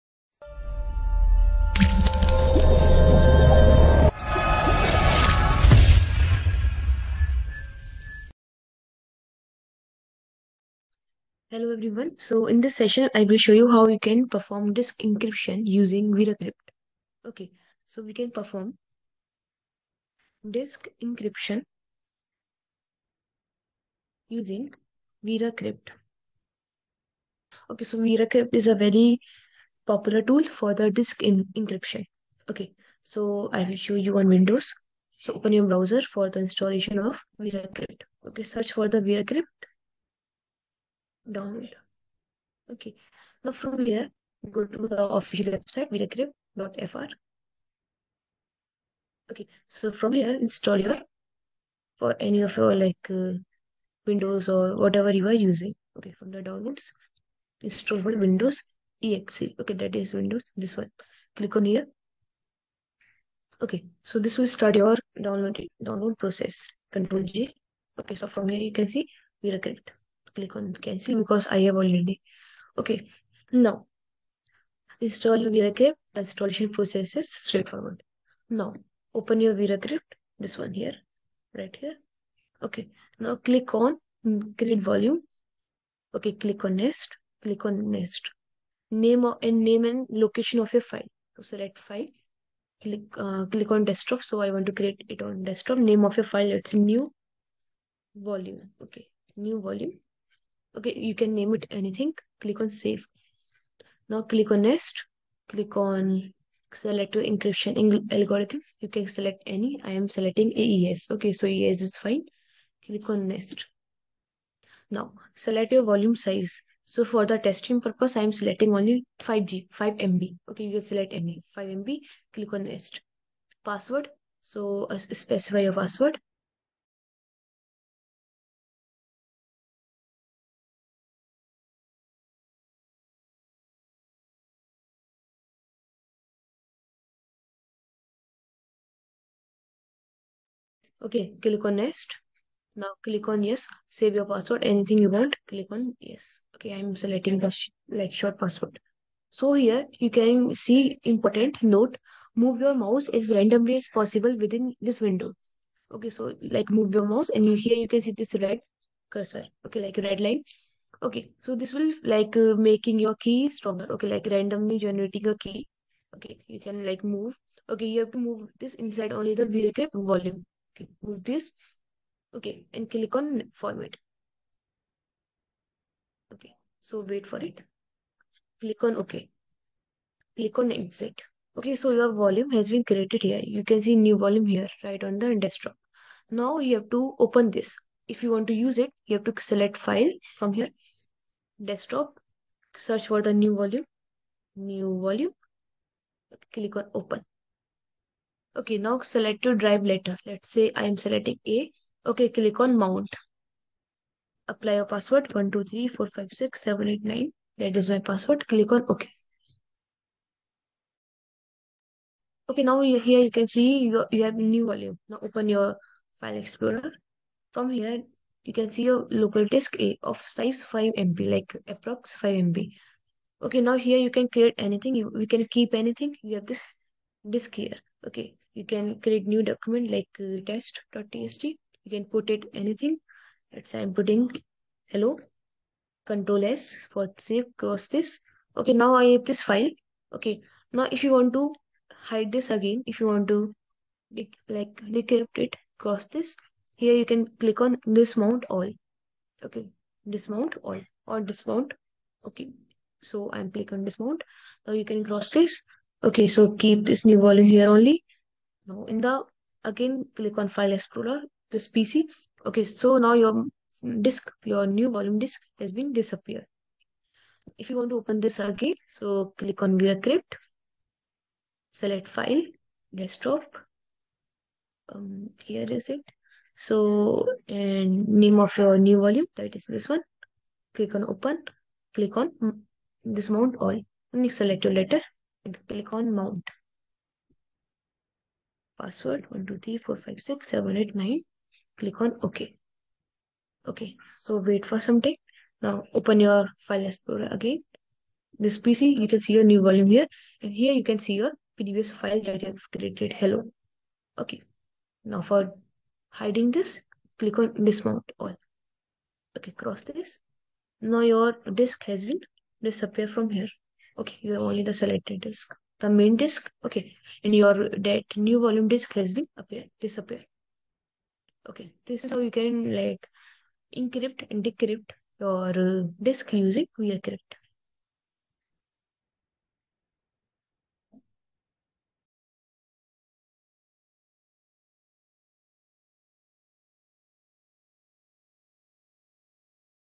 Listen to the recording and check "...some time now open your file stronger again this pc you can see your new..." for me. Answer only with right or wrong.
wrong.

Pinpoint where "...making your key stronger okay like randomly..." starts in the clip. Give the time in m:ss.
2:42.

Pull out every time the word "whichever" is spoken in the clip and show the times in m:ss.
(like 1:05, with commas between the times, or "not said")
not said.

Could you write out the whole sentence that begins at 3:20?
Let's say I am selecting A.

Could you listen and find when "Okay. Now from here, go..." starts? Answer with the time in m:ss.
0:42.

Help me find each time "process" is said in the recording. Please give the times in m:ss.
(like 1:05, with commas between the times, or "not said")
1:06, 1:16.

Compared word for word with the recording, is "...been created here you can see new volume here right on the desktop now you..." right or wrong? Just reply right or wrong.
right.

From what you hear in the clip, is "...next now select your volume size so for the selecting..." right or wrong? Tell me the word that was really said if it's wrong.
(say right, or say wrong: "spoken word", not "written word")
wrong: "testing", not "selecting".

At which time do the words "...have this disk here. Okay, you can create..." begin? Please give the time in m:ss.
3:46.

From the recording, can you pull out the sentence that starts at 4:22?
Okay, so now your disk, your new volume disk has been disappeared.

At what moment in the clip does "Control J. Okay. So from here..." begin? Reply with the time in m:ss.
1:06.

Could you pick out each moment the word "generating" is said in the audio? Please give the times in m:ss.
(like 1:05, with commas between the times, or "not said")
2:44.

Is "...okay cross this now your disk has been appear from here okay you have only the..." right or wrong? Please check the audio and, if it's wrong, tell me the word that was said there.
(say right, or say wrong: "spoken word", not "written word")
wrong: "disappear", not "appear".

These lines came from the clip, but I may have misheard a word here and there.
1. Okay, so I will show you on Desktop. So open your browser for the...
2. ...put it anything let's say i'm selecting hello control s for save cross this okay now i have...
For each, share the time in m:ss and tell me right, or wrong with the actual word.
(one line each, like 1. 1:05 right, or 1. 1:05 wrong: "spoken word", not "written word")
1. 0:32 wrong: "Windows", not "Desktop"
2. 3:52 wrong: "putting", not "selecting".